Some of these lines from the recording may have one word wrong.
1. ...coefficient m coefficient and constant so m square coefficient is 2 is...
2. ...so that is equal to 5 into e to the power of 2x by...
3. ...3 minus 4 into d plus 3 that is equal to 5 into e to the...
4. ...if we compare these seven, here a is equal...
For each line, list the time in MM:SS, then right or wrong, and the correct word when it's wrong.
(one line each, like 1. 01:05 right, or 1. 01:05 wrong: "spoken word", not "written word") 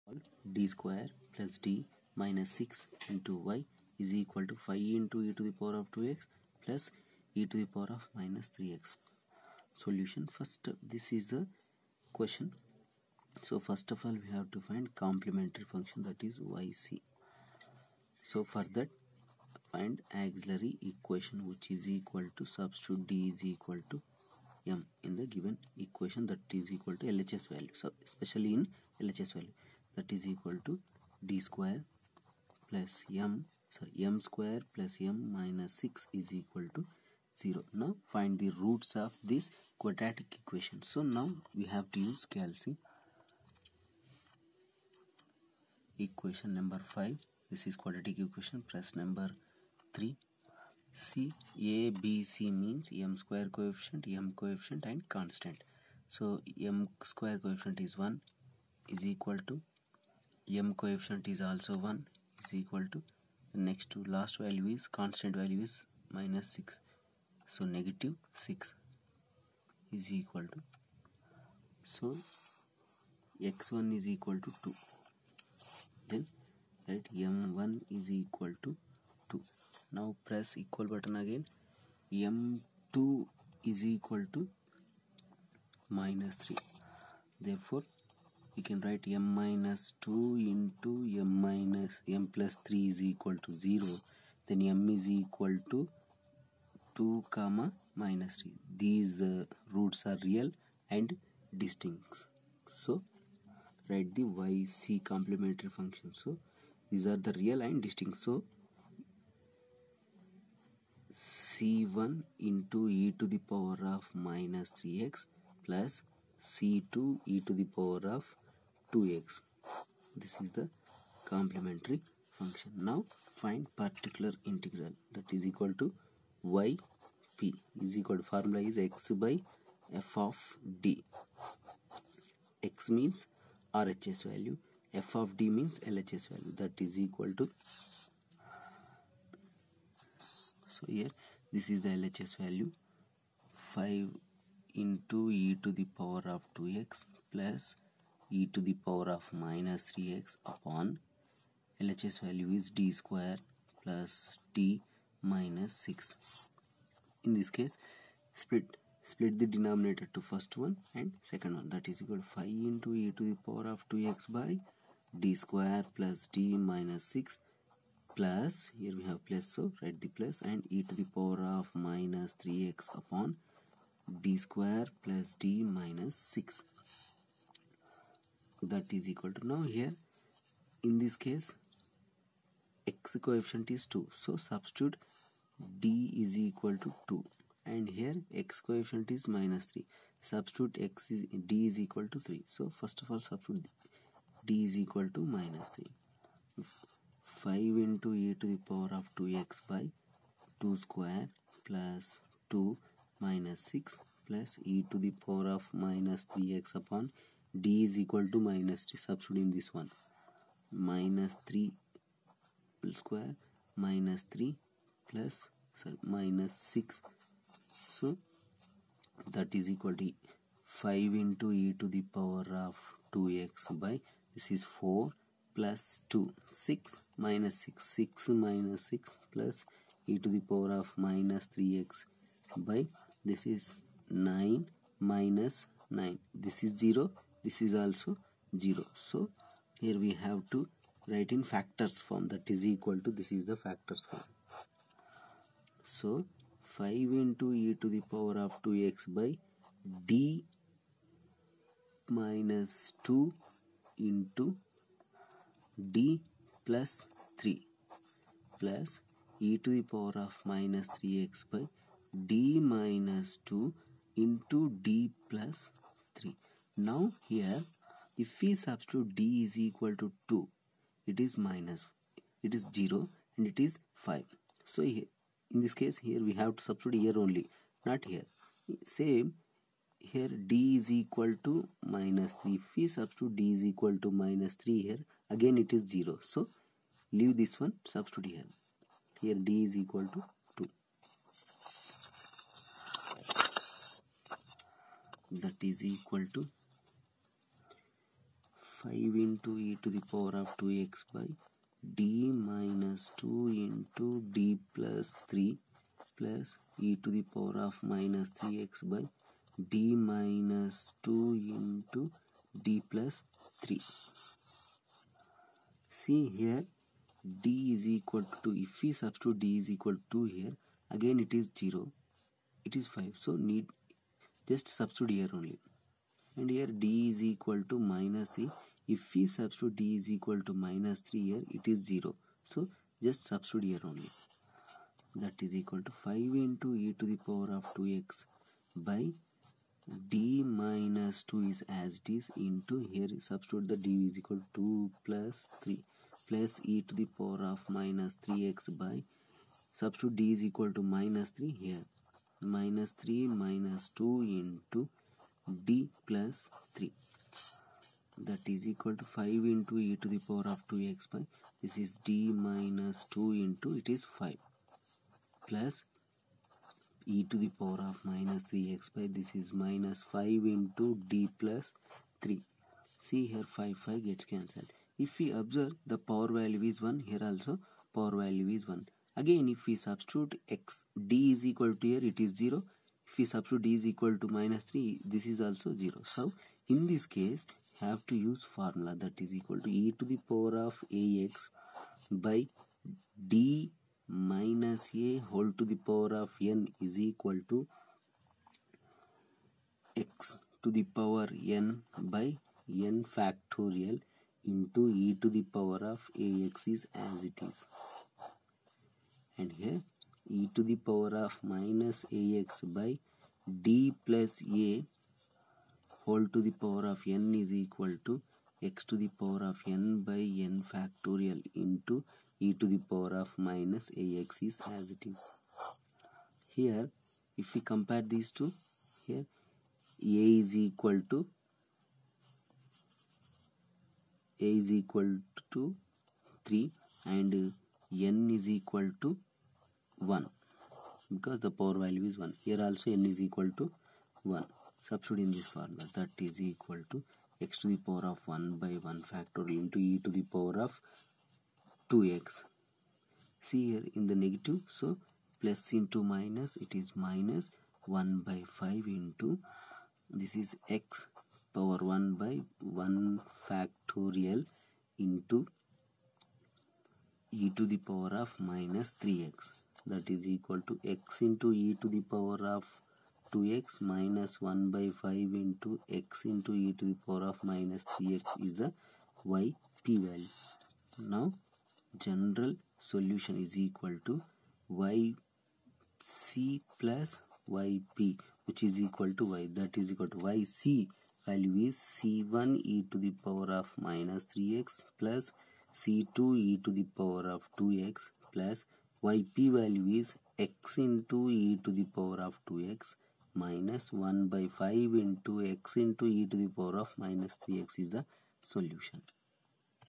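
1. 00:53 wrong: "1", not "2"
2. 03:37 right
3. 05:53 wrong: "2", not "4"
4. 07:07 wrong: "two", not "seven".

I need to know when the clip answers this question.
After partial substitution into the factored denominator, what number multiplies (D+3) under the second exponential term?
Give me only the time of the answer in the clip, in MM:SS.
06:09.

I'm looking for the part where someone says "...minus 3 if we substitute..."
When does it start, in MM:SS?
04:41.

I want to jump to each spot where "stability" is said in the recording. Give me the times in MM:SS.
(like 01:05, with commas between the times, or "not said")
not said.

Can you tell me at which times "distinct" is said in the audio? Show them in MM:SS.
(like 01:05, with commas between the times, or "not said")
01:41, 01:47.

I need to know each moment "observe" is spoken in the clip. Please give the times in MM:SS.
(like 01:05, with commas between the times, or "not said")
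06:15.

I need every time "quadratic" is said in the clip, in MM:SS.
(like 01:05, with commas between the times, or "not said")
00:39, 00:47.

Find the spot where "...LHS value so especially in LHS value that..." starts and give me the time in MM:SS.
00:27.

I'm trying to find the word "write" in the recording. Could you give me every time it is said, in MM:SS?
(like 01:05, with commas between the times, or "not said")
01:28, 01:43, 02:49, 04:01.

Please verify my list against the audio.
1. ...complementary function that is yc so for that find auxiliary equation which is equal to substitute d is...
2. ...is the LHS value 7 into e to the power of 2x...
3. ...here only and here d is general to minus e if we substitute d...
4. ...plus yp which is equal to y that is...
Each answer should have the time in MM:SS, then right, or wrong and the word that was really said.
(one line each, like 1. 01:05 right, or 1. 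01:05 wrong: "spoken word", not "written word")
1. 00:15 right
2. 02:21 wrong: "5", not "7"
3. 05:25 wrong: "equal", not "general"
4. 08:06 right.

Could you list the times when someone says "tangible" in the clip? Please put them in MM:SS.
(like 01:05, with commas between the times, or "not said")
not said.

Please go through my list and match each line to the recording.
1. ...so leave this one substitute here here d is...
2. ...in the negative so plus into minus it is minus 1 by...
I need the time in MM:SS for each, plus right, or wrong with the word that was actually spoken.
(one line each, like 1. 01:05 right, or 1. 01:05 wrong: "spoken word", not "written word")
1. 04:46 right
2. 07:33 right.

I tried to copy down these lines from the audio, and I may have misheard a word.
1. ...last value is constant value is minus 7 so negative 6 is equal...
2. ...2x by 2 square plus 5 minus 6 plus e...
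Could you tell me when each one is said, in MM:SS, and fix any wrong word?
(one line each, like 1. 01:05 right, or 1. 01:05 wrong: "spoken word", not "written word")
1. 01:04 wrong: "6", not "7"
2. 03:19 wrong: "2", not "5".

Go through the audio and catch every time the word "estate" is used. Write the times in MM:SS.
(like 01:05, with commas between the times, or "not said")
not said.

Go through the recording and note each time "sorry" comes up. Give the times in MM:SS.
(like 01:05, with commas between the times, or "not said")
00:33, 03:35.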